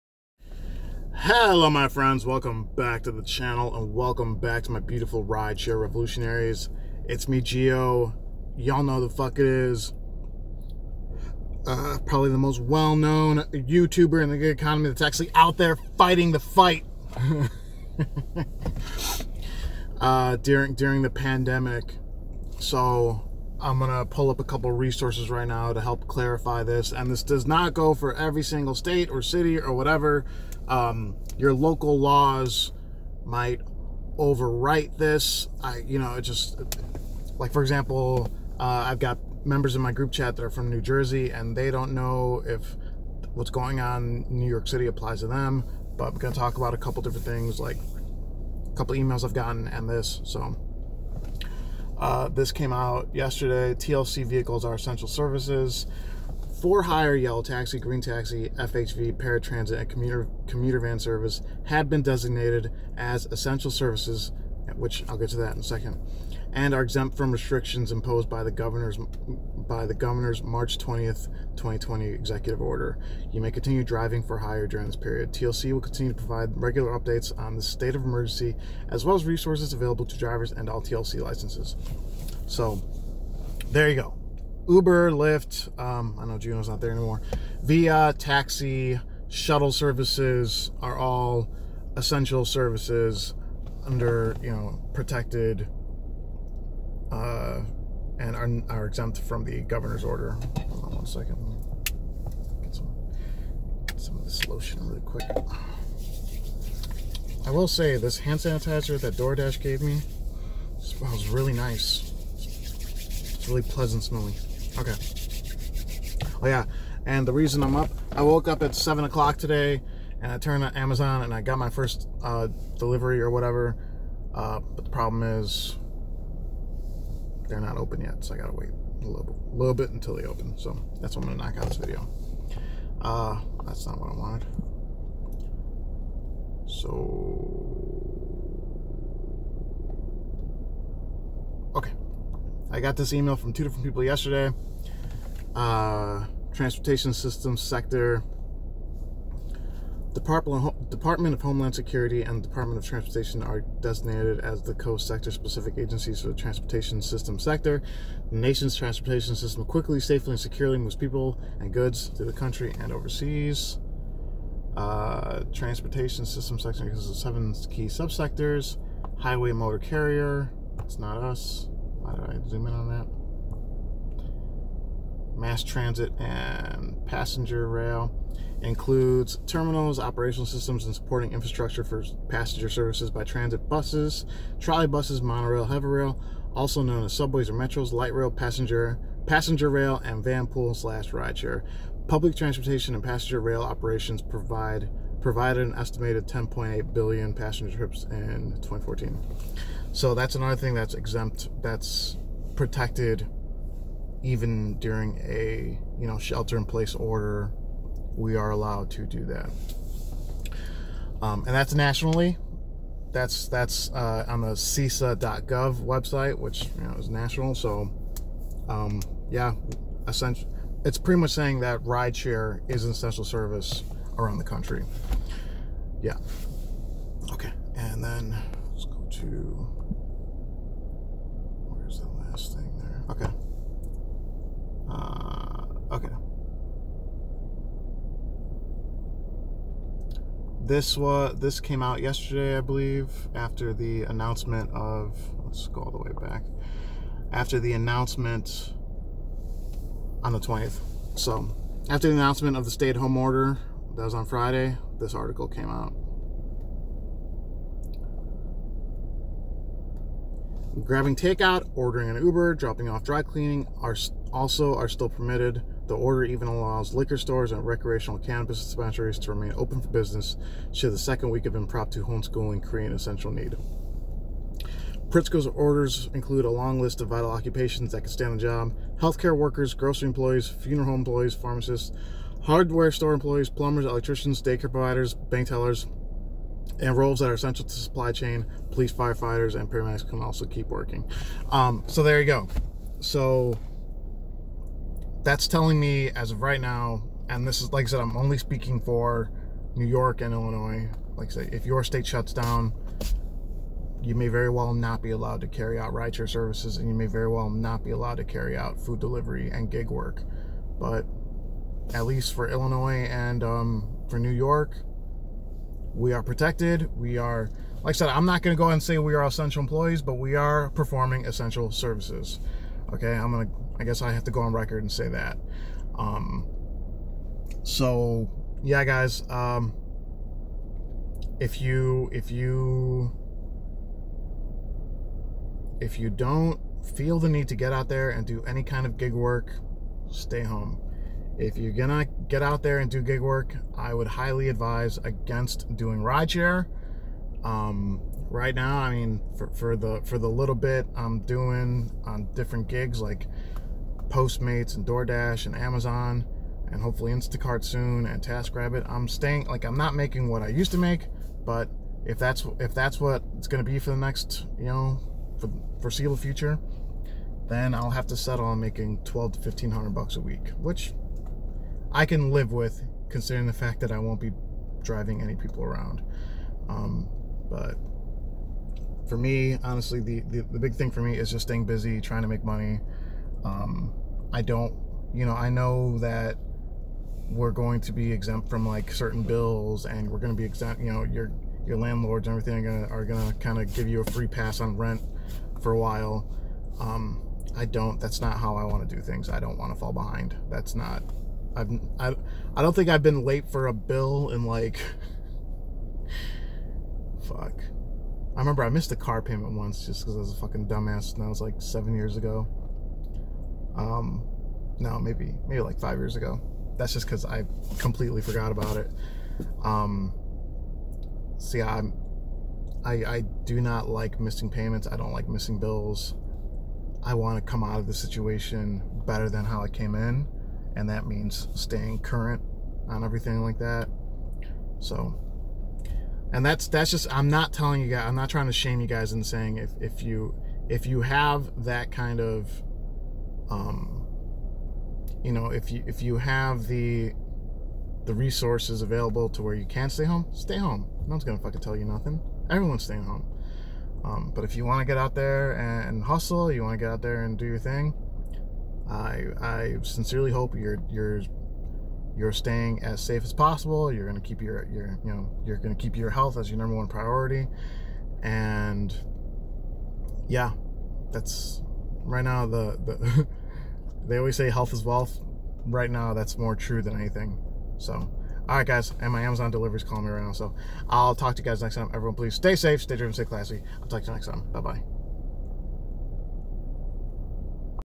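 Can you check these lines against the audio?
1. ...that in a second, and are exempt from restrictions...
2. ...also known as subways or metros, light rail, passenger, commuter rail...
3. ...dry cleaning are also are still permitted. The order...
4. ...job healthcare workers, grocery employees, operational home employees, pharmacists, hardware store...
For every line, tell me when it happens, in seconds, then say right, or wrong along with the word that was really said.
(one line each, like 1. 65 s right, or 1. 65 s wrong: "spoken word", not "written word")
1. 65 s right
2. 186 s wrong: "passenger", not "commuter"
3. 263 s right
4. 278 s wrong: "funeral", not "operational".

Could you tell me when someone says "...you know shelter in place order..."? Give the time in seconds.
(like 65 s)
205 s.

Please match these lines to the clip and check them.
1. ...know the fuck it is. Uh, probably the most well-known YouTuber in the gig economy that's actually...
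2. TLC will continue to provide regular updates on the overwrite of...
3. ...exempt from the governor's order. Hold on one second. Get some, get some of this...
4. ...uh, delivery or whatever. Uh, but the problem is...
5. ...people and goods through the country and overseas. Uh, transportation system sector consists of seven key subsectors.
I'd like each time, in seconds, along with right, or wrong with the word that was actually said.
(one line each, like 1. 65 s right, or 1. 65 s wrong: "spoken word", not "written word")
1. 8 s right
2. 75 s wrong: "state", not "overwrite"
3. 98 s right
4. 122 s right
5. 160 s right.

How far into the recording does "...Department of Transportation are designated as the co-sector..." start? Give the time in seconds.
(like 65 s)
152 s.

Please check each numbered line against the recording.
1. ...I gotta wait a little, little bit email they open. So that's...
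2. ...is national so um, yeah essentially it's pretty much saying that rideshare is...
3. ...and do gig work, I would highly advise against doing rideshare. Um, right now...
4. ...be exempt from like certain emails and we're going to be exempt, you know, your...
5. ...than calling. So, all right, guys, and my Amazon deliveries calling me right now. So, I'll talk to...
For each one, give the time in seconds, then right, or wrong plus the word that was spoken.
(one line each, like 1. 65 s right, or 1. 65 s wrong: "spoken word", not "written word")
1. 128 s wrong: "until", not "email"
2. 216 s right
3. 342 s right
4. 387 s wrong: "bills", not "emails"
5. 476 s wrong: "anything", not "calling".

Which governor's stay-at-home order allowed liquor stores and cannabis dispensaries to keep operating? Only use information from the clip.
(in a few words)
Pritzker.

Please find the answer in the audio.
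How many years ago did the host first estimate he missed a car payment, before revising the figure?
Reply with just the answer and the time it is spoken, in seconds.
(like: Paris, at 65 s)
7 years, at 411 s.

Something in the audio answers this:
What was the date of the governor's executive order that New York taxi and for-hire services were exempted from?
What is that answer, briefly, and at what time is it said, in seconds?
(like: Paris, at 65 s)
March 20th, 2020, at 70 s.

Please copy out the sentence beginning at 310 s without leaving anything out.
But at least for Illinois and um, for New York, we are protected.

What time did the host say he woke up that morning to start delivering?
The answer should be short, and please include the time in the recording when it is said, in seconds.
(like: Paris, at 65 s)
7 o'clock, at 118 s.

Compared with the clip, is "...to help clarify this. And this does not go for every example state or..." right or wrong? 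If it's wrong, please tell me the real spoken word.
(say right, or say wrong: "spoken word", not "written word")
wrong: "single", not "example".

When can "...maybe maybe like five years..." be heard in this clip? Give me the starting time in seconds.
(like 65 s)
414 s.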